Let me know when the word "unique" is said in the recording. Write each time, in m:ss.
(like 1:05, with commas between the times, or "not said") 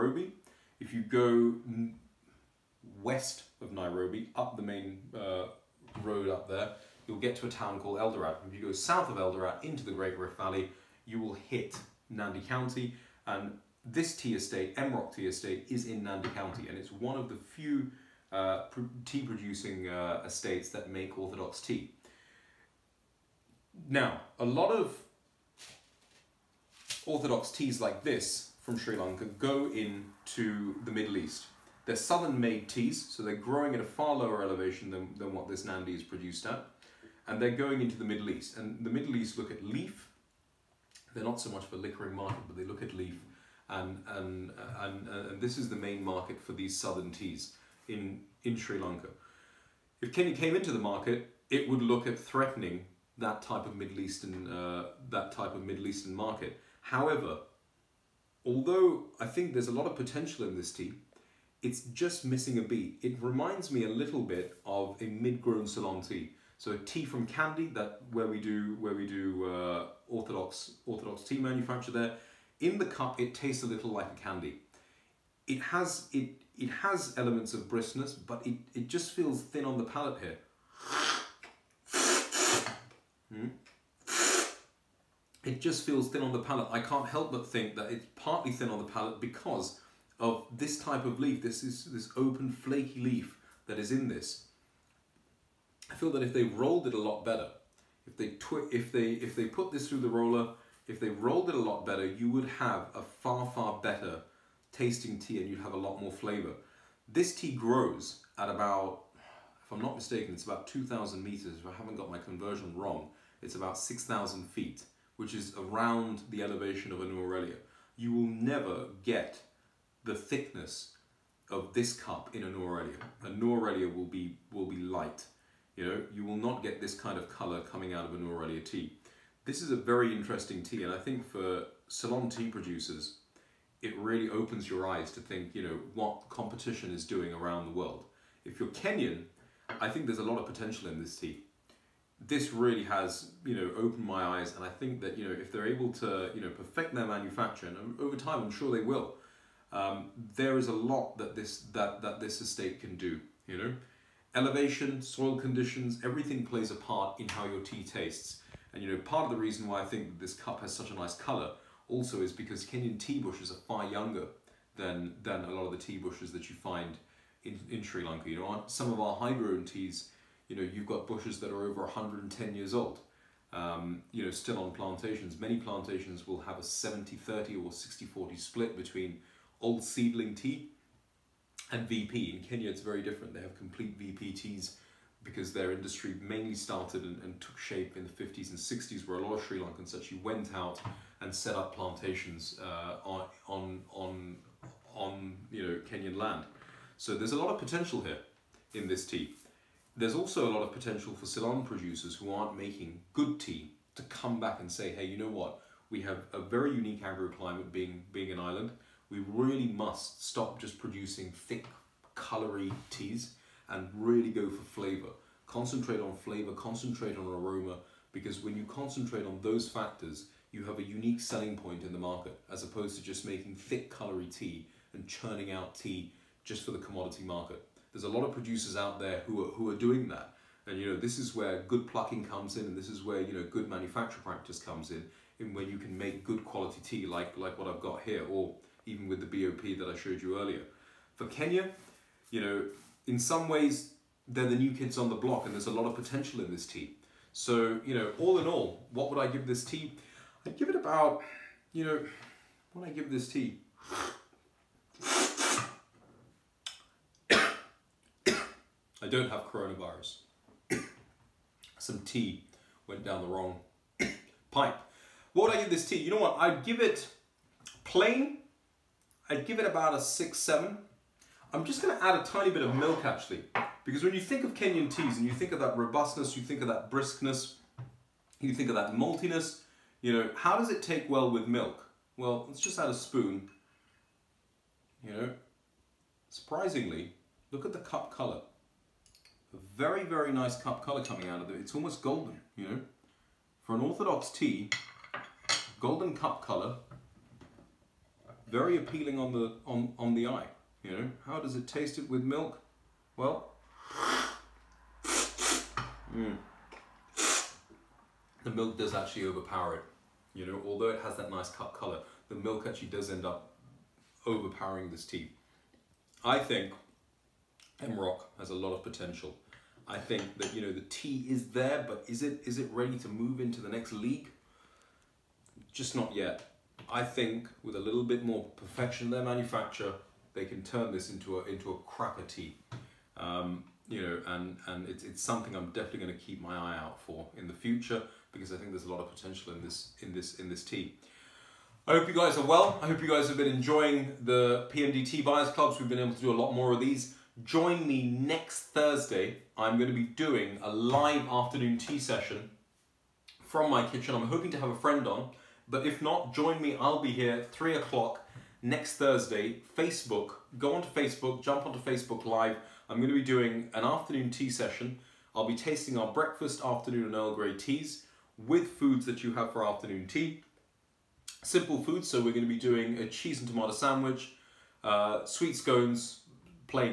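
3:26, 3:40.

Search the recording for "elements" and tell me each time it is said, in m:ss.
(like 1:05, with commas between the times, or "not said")
1:17.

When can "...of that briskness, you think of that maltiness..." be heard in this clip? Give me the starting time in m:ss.
4:36.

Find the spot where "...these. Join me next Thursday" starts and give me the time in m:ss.
5:46.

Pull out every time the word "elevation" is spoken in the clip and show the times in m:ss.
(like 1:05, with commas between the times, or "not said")
0:34, 1:56, 2:34.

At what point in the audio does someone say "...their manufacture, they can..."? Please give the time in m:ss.
5:29.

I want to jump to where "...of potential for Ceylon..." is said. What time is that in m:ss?
3:20.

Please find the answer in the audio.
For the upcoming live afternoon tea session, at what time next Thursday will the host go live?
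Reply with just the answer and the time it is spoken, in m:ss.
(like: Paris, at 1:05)
3 o'clock, at 5:57.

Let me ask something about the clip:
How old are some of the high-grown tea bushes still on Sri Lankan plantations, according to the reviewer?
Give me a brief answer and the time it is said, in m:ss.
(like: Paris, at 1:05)
over 110 years, at 2:51.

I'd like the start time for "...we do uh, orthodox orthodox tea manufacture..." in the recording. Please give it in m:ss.
1:08.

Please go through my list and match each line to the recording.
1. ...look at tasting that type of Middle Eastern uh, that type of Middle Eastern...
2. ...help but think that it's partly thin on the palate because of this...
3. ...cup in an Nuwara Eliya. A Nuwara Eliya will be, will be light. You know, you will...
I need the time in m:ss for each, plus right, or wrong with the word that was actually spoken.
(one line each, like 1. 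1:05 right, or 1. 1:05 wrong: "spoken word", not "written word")
1. 0:51 wrong: "threatening", not "tasting"
2. 1:27 right
3. 2:01 right.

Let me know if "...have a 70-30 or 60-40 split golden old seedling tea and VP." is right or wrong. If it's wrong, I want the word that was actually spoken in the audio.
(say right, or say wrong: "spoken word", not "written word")
wrong: "between", not "golden".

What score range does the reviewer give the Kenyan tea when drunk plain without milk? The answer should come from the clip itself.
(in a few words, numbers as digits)
6 to 7.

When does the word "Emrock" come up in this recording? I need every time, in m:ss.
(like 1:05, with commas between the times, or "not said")
0:14, 5:17.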